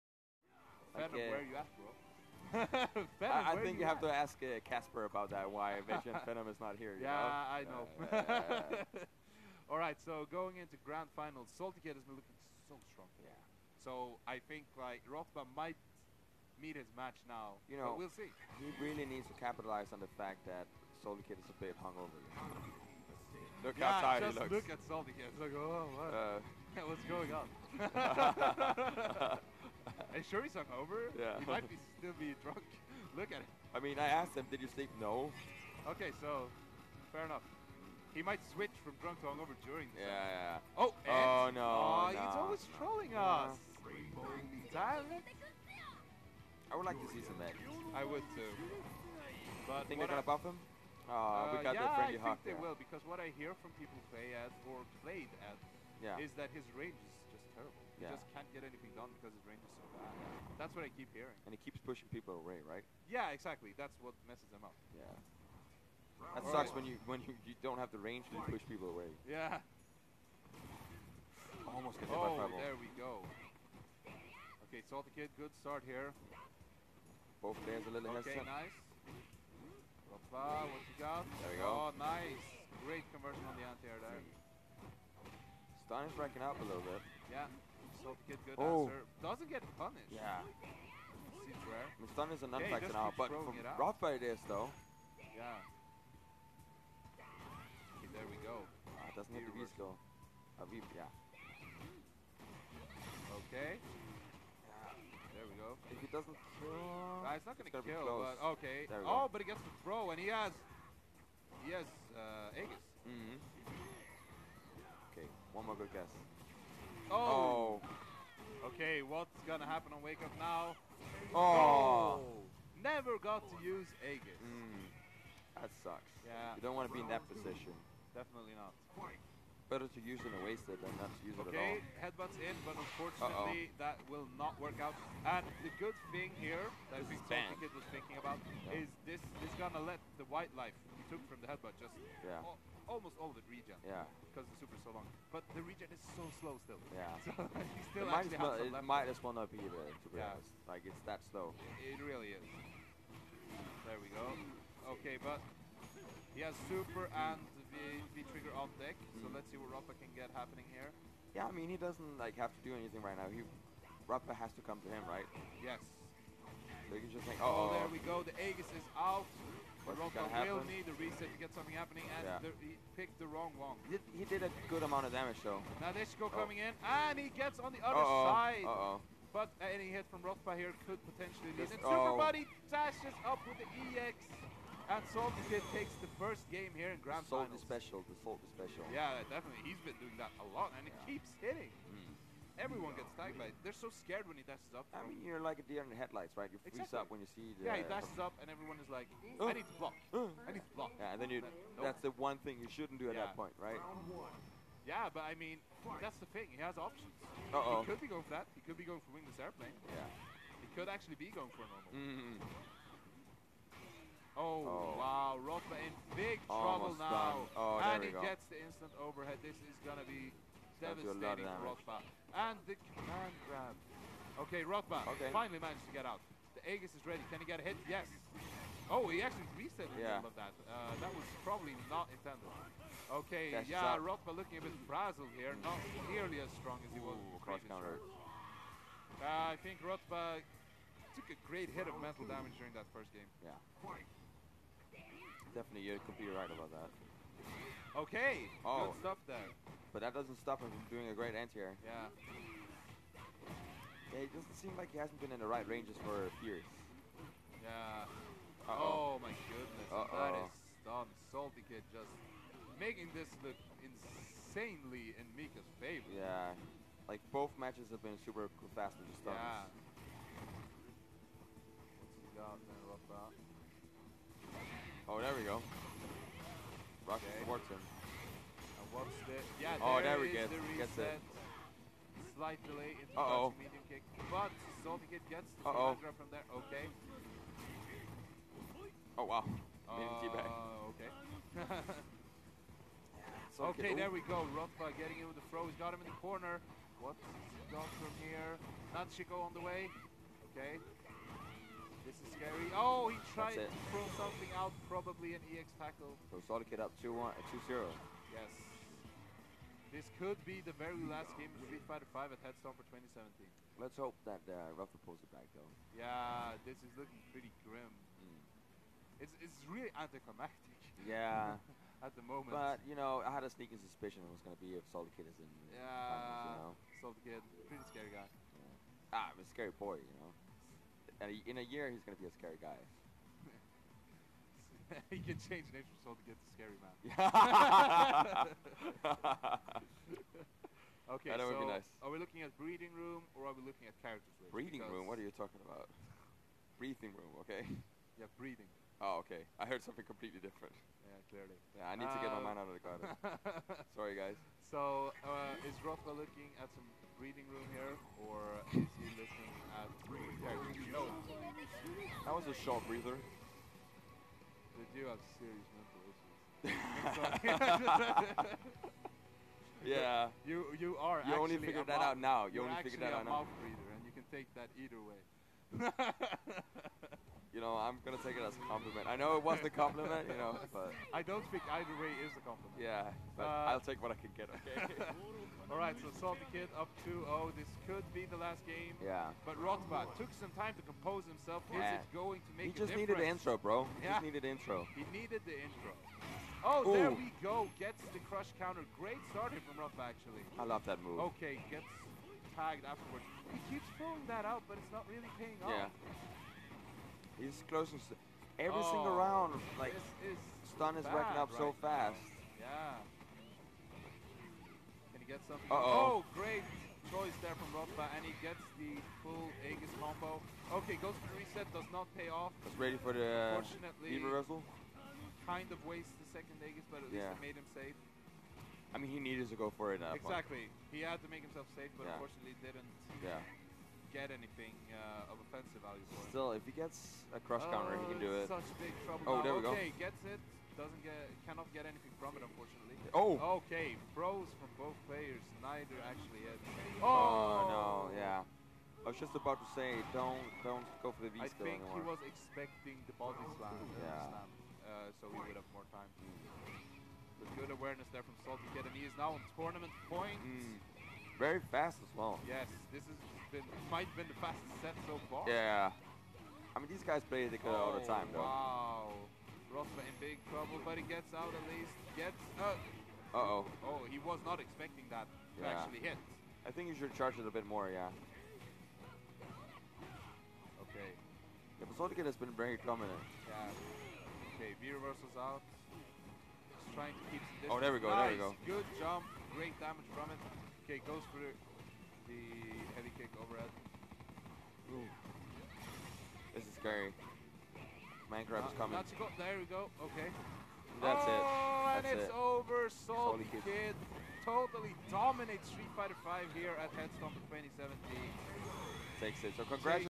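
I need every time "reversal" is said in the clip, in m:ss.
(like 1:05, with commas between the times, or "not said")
7:04, 8:04.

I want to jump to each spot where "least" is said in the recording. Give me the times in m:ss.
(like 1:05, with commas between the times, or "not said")
7:07, 7:51.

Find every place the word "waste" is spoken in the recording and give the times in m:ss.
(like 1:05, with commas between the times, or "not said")
2:10, 7:05.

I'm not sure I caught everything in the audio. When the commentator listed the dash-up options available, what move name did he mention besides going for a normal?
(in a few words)
wingless airplane.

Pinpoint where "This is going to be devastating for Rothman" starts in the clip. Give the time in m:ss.
3:39.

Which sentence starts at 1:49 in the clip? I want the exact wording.
Oh, but he gets the throw, and he has...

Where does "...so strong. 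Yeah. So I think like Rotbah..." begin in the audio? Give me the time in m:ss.
0:12.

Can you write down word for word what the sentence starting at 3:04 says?
Hats salty Kid takes the first game here in Grand Sold Finals.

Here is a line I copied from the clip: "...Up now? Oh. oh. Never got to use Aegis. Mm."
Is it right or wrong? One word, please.
right.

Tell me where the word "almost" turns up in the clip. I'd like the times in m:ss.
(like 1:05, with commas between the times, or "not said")
1:11, 2:22, 3:36.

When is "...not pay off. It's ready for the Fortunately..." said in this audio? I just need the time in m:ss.
7:01.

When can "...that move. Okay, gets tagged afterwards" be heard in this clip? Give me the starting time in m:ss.
6:40.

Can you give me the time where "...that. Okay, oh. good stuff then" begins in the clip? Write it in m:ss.
4:06.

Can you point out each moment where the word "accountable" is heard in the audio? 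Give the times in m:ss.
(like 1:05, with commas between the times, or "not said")
not said.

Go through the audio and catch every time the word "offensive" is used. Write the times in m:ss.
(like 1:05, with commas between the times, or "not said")
7:15.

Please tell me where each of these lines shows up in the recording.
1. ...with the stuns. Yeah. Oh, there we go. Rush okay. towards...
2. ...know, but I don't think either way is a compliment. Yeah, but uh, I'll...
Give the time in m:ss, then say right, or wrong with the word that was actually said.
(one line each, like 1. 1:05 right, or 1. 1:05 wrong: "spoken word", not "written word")
1. 4:28 right
2. 6:20 right.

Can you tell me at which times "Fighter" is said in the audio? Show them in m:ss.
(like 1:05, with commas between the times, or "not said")
5:11, 8:25.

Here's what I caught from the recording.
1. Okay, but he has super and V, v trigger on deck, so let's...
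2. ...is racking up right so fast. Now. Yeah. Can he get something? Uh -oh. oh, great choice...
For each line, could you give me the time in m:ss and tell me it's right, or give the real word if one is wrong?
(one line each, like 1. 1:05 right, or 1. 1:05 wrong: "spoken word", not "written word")
1. 2:34 right
2. 6:50 right.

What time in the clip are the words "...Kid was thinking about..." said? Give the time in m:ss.
2:17.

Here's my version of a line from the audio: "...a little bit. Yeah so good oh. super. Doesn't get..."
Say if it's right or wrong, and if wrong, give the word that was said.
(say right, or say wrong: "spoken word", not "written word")
wrong: "answer", not "super".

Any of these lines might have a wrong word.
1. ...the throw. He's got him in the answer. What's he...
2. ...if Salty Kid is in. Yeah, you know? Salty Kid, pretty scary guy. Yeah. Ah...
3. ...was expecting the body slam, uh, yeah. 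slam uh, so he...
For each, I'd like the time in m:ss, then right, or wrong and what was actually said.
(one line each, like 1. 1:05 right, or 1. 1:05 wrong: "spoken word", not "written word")
1. 4:55 wrong: "corner", not "answer"
2. 5:24 right
3. 7:32 right.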